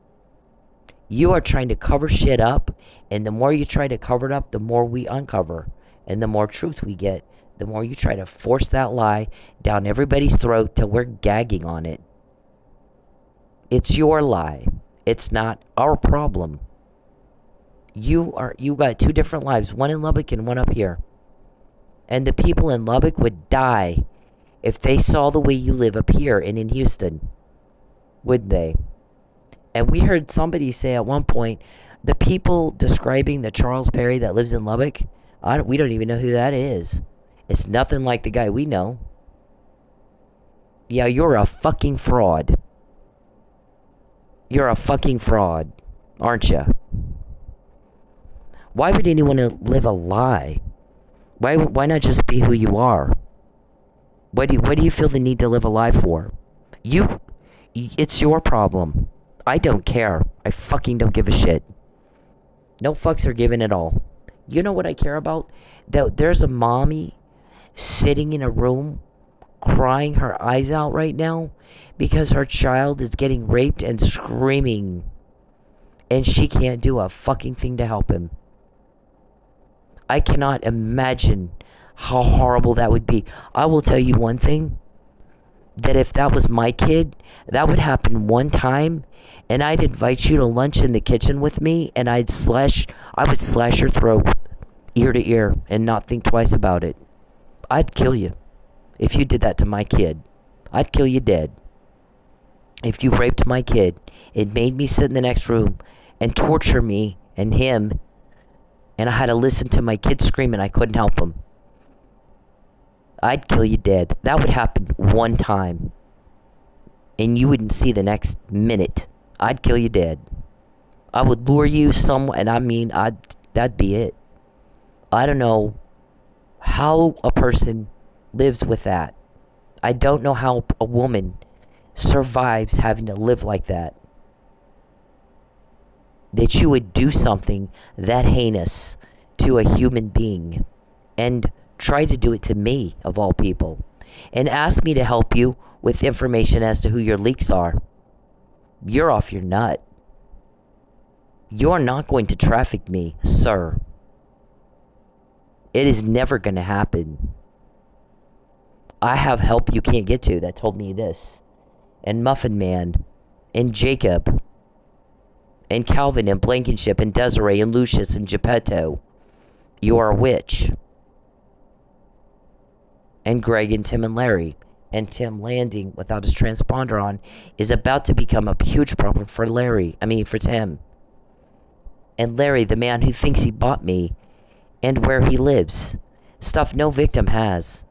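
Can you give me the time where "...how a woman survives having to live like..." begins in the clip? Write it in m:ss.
2:10.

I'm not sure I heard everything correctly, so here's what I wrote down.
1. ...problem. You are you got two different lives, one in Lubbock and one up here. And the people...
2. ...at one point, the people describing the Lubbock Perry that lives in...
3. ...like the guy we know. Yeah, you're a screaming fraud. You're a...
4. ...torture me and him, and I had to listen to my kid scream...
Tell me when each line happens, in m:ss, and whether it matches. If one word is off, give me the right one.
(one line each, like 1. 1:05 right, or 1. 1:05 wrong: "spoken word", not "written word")
1. 0:15 right
2. 0:30 wrong: "Charles", not "Lubbock"
3. 0:38 wrong: "fucking", not "screaming"
4. 1:46 right.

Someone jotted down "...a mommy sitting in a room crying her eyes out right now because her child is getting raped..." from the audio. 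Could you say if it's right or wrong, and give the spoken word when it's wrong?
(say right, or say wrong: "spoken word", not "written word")
right.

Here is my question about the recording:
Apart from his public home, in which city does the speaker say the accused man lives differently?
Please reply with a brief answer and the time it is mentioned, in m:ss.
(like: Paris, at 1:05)
Houston, at 0:26.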